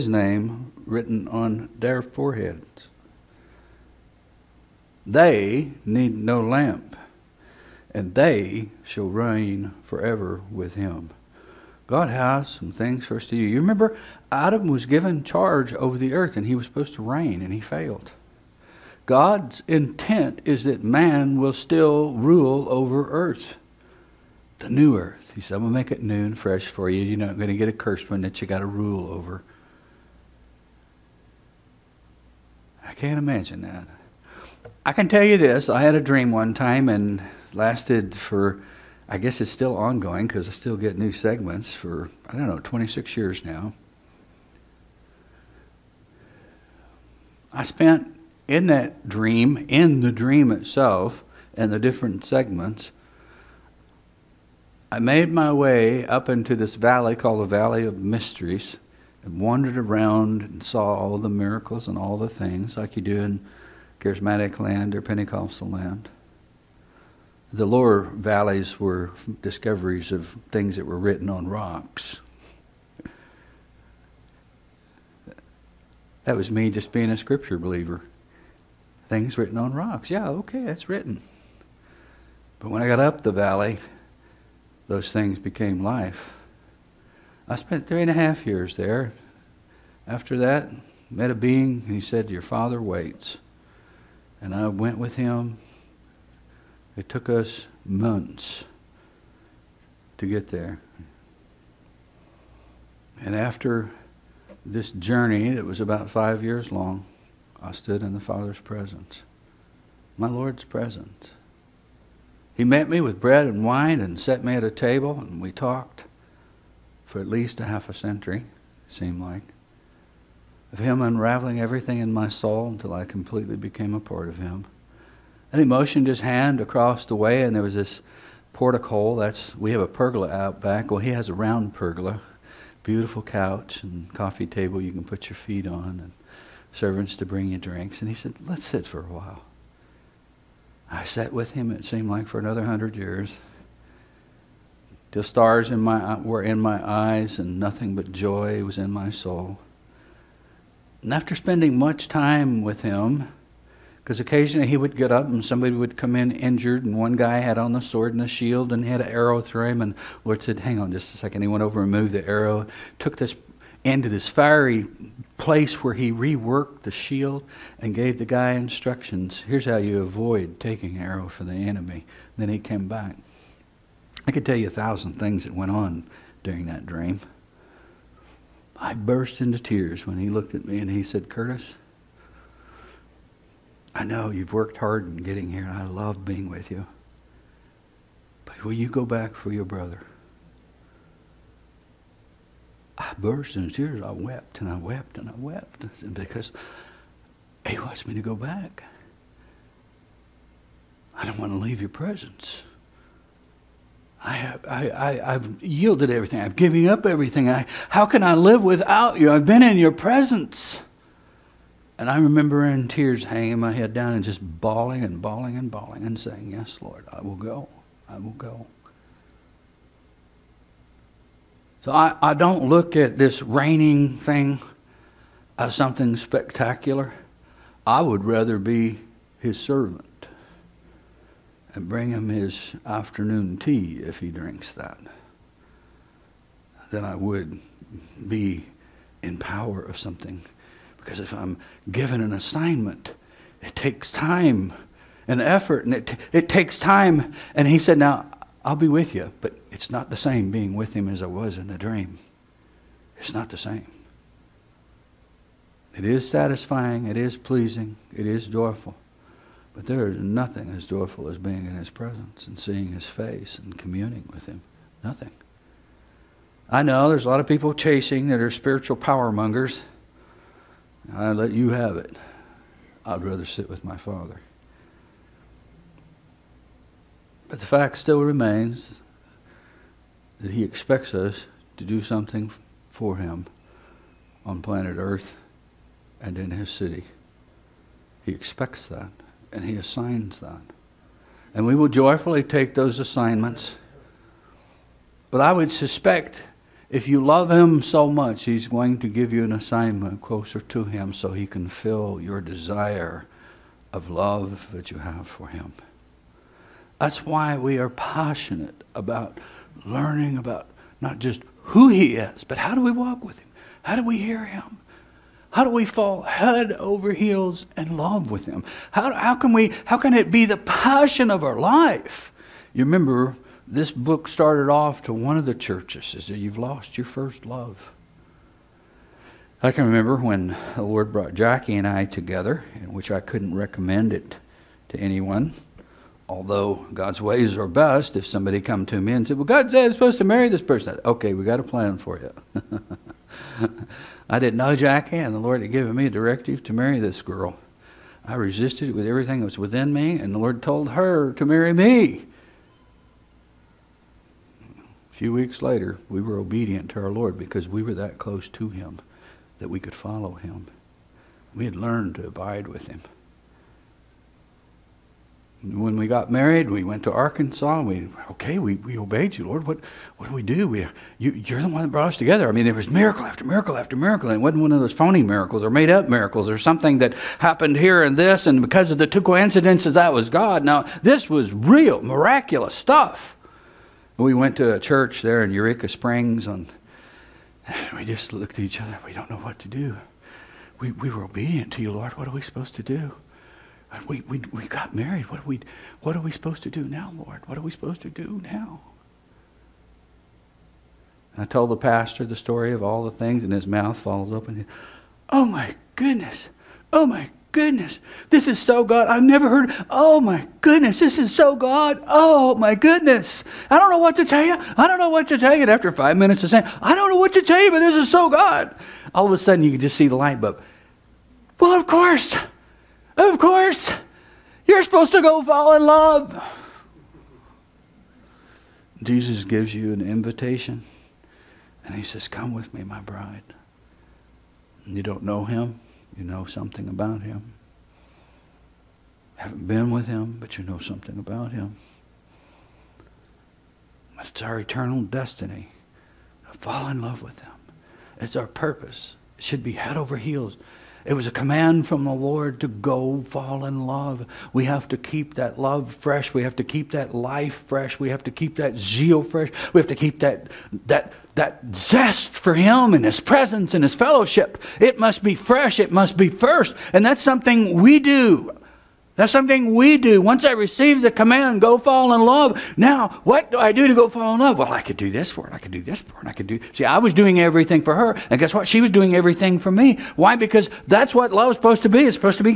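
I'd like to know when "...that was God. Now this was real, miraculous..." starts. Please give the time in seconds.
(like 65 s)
379 s.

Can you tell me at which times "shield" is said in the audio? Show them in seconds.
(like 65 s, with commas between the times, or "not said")
158 s, 166 s.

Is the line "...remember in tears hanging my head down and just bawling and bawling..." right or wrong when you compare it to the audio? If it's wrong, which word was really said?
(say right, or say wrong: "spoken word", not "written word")
right.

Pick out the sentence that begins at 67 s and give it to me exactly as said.
The lower valleys were discoveries of things that were written on rocks.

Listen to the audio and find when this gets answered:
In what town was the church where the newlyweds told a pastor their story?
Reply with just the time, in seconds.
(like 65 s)
385 s.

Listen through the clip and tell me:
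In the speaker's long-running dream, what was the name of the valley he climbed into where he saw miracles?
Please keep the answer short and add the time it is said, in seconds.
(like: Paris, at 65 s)
Valley of Mysteries, at 57 s.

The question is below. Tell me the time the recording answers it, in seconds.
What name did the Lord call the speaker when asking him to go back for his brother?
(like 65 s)
181 s.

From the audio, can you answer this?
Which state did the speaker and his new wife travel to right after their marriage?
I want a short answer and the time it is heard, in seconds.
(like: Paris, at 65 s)
Arkansas, at 367 s.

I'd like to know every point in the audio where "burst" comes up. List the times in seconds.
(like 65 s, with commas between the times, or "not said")
178 s, 193 s.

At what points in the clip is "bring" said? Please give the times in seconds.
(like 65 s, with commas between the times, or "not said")
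137 s, 231 s.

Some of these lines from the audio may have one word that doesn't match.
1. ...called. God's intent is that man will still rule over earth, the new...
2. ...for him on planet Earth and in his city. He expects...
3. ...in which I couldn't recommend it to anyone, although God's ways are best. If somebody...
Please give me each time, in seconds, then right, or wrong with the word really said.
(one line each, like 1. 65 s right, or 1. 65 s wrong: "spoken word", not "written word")
1. 17 s wrong: "failed", not "called"
2. 282 s right
3. 332 s right.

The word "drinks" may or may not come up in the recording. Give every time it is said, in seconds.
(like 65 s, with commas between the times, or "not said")
137 s, 234 s.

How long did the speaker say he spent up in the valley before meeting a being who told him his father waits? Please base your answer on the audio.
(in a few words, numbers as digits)
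3.5 years.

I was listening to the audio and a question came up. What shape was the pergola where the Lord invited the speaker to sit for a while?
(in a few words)
Round.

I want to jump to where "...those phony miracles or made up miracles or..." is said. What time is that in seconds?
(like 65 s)
374 s.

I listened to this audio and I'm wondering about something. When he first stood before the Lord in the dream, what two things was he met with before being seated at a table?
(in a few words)
Bread and wine.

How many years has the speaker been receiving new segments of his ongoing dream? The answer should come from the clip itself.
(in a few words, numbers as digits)
26.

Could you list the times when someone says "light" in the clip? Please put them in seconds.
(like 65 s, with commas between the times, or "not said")
420 s.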